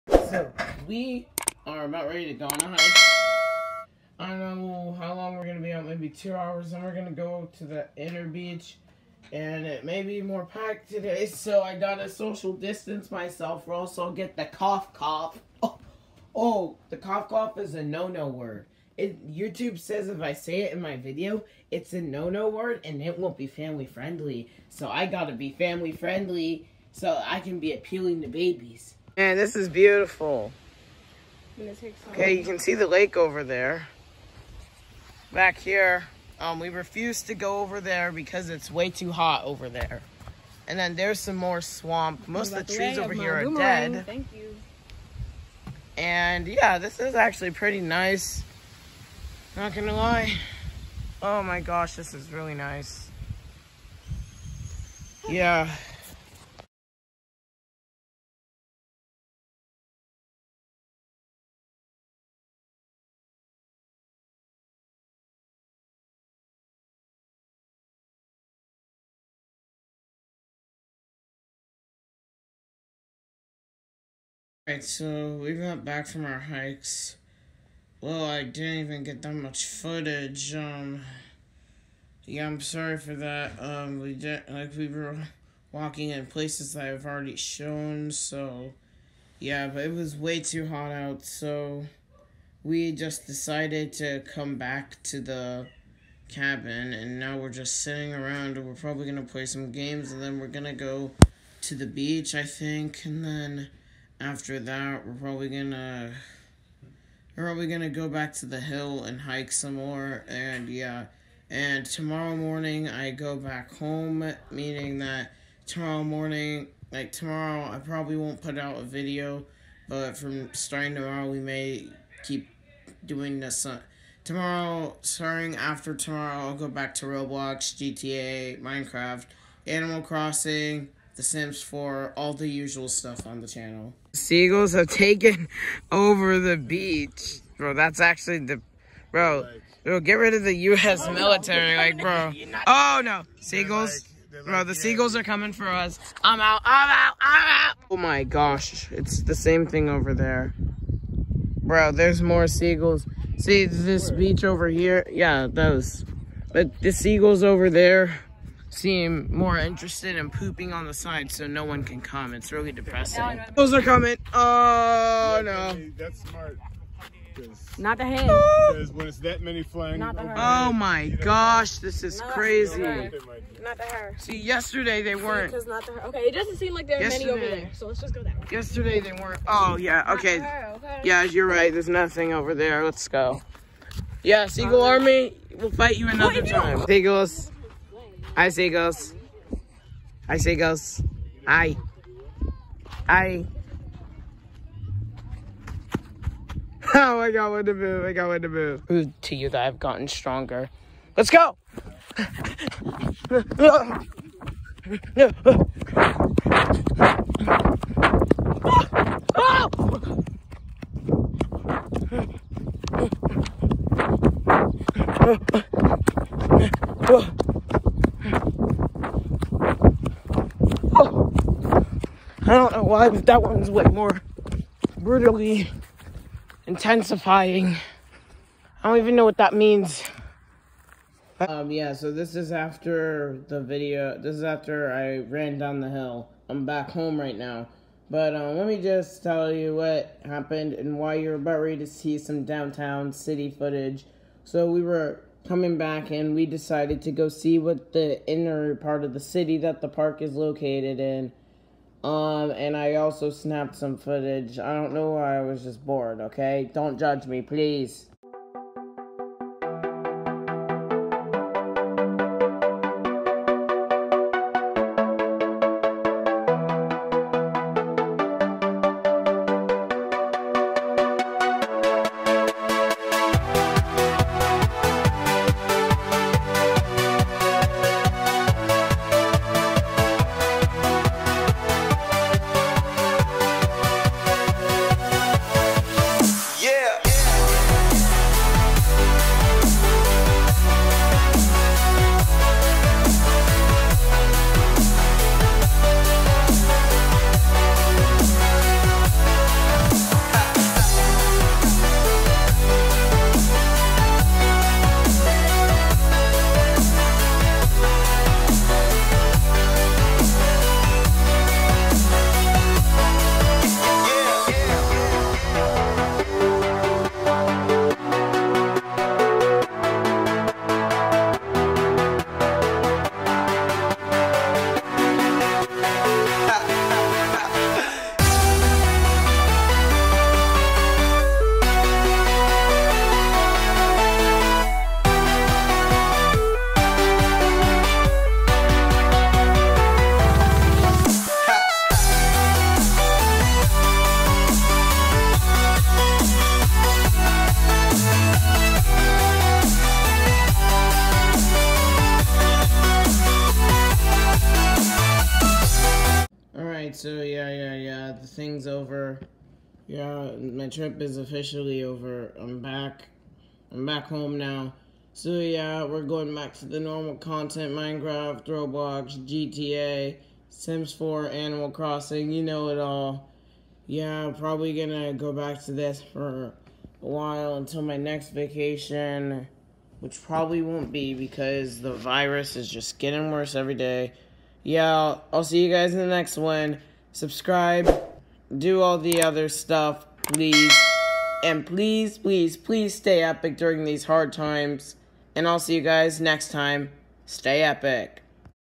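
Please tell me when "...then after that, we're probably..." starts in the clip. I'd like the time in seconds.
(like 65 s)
103 s.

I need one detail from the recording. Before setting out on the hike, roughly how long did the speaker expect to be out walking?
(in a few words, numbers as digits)
2 hours.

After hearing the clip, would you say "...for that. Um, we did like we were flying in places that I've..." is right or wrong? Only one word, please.
wrong.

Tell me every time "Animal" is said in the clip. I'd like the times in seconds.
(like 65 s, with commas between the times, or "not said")
129 s, 371 s.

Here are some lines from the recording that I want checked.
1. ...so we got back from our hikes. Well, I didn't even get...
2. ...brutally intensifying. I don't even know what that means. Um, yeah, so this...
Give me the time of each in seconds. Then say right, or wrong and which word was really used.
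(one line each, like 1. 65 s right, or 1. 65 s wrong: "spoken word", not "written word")
1. 74 s right
2. 224 s right.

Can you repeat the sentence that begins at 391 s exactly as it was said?
And please, please, please stay epic during these hard times.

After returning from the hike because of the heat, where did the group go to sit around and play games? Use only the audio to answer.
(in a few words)
the cabin.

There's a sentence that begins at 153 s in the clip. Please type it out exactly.
See, this beach over here, yeah, those.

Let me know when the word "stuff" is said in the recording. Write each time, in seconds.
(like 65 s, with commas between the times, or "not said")
132 s, 389 s.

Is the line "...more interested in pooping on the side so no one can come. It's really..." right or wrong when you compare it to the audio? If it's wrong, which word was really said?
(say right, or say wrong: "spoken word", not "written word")
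right.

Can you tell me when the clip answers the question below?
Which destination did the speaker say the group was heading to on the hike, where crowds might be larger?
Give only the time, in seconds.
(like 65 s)
7 s.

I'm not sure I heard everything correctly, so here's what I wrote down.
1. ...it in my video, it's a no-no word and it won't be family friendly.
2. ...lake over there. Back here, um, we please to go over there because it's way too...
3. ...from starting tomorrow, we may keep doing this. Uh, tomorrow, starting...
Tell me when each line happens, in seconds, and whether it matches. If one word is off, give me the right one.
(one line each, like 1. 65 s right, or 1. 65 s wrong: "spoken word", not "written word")
1. 20 s right
2. 32 s wrong: "refuse", not "please"
3. 120 s right.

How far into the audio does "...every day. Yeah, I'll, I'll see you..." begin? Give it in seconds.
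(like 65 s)
383 s.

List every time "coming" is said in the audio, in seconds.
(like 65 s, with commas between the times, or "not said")
145 s, 163 s, 245 s.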